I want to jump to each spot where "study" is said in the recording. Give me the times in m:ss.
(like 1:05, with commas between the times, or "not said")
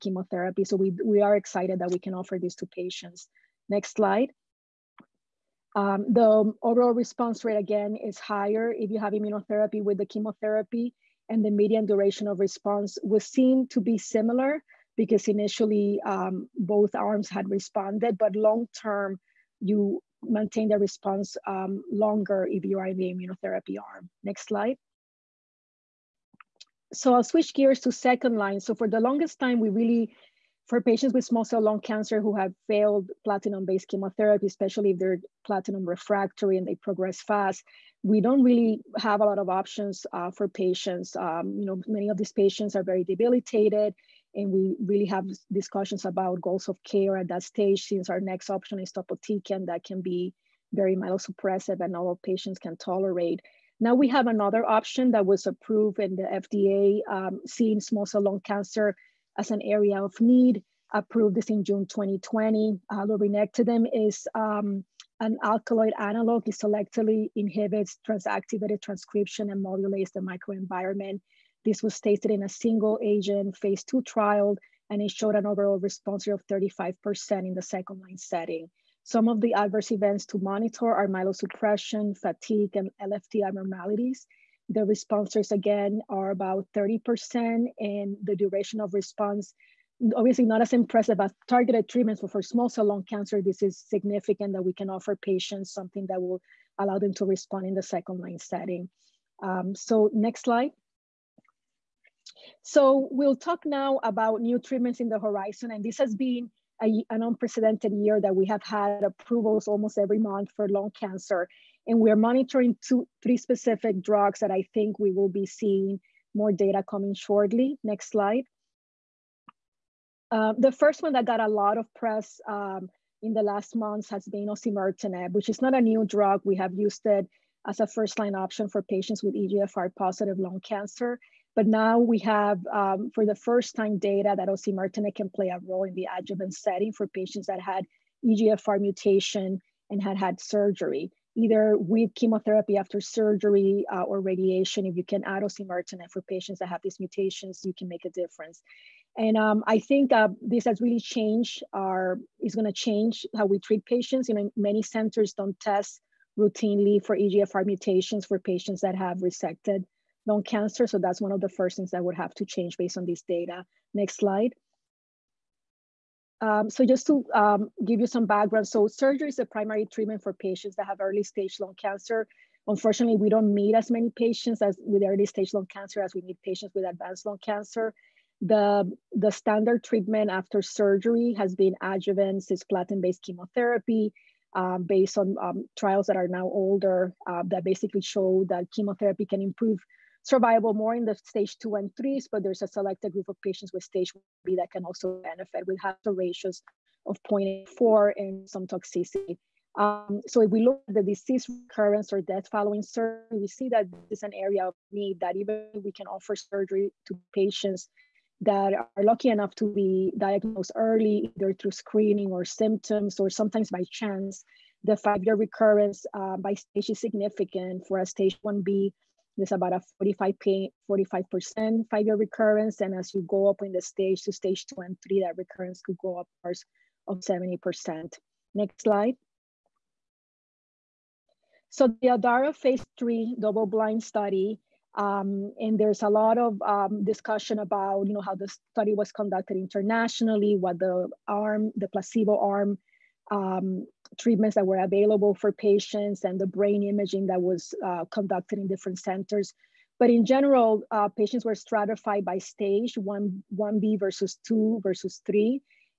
3:54, 3:58.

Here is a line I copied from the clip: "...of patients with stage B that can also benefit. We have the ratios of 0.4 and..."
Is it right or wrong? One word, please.
right.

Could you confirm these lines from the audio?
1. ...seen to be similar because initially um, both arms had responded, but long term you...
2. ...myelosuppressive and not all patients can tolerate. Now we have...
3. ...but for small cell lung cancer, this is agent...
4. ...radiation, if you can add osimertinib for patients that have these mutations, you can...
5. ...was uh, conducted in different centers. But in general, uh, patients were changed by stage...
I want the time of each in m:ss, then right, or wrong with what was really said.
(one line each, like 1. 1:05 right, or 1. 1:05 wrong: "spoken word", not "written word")
1. 0:13 right
2. 0:50 right
3. 1:32 wrong: "significant", not "agent"
4. 2:24 right
5. 4:07 wrong: "stratified", not "changed".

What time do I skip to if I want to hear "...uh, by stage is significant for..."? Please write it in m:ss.
3:36.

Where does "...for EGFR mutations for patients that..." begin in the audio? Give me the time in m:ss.
2:37.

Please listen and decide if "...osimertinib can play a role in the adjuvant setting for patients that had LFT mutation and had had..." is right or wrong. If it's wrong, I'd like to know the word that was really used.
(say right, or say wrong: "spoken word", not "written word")
wrong: "EGFR", not "LFT".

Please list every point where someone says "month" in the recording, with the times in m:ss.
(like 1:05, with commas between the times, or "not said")
1:50, 2:03.